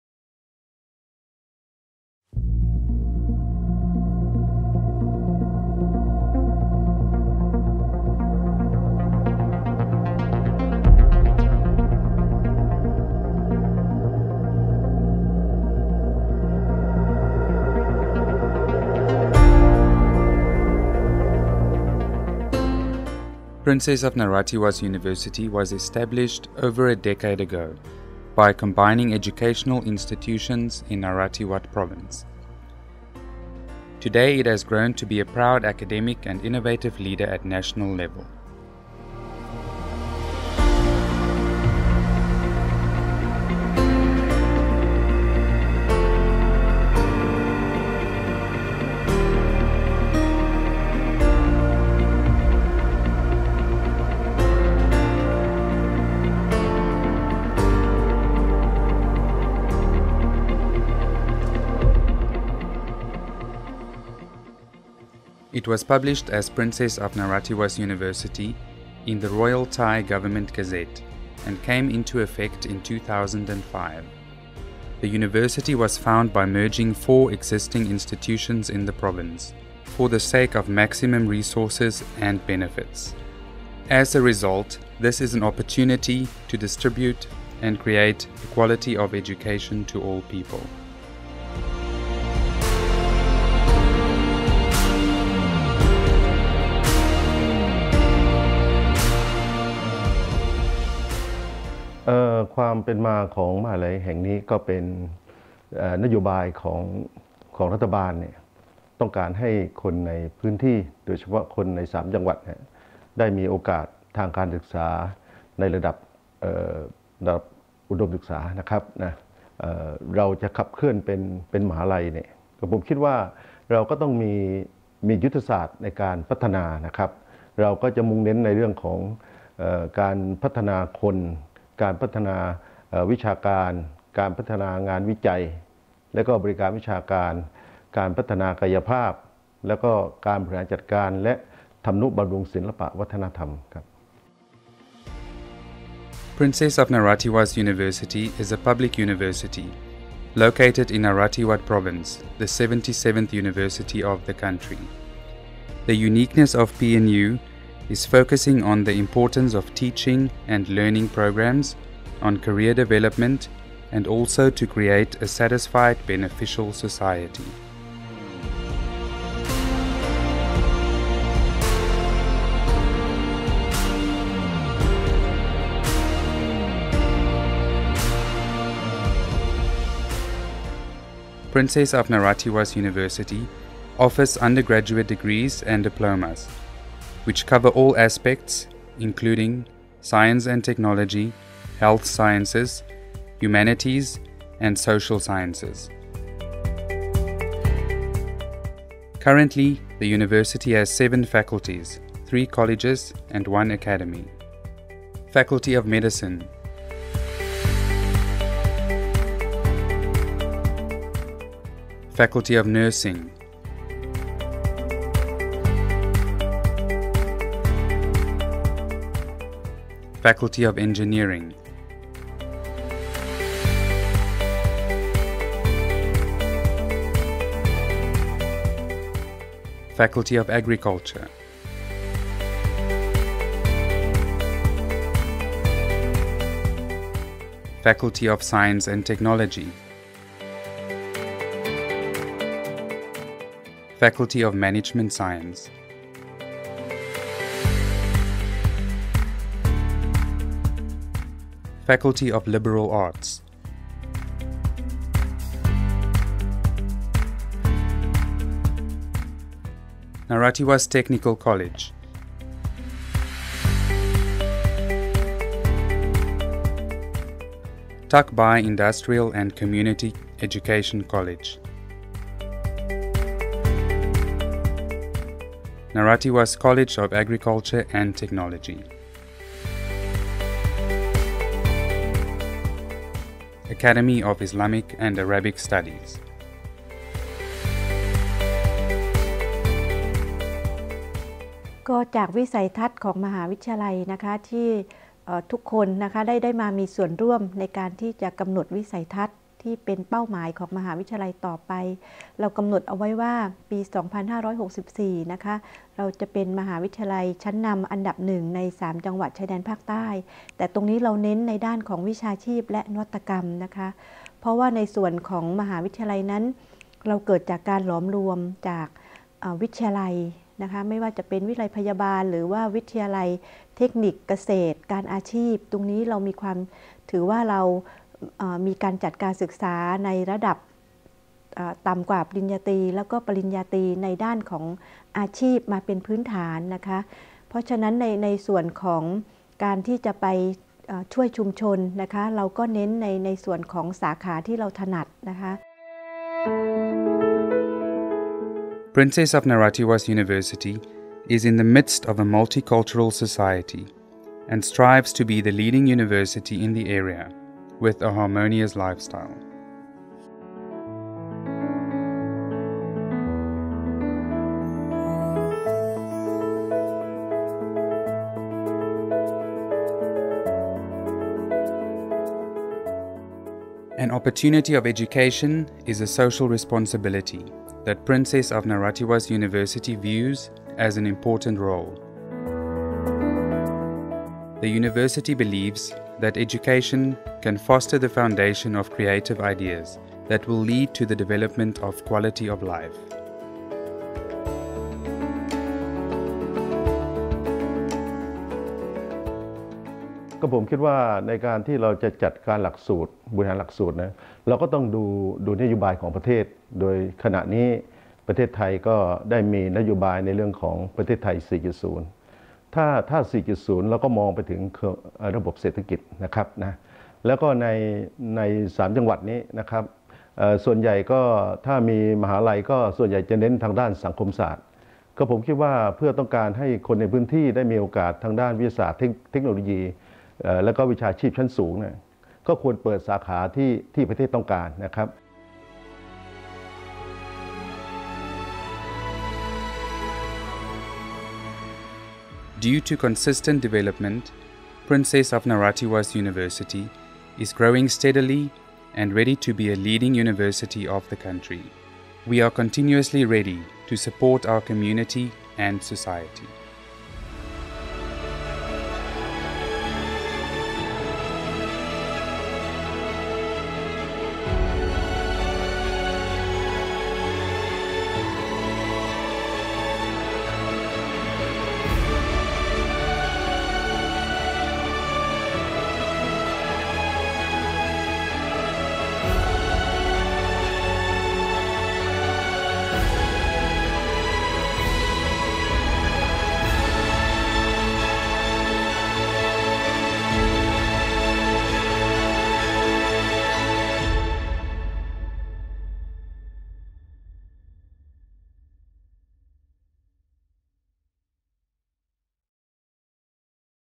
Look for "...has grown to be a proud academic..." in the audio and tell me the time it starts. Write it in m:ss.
0:34.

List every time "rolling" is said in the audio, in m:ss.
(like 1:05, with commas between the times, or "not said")
not said.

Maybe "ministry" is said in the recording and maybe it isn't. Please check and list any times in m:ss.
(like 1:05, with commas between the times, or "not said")
not said.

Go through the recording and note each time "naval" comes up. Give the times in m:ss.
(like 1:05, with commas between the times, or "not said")
not said.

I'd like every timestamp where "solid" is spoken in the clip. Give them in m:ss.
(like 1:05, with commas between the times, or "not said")
not said.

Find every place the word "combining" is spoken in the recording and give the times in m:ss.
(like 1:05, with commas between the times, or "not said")
0:28.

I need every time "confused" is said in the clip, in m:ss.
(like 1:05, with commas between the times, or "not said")
not said.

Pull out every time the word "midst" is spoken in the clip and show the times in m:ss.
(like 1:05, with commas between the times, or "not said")
5:51.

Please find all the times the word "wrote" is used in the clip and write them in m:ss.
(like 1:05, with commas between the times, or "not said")
not said.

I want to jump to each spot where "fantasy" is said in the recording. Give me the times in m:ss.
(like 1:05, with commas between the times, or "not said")
not said.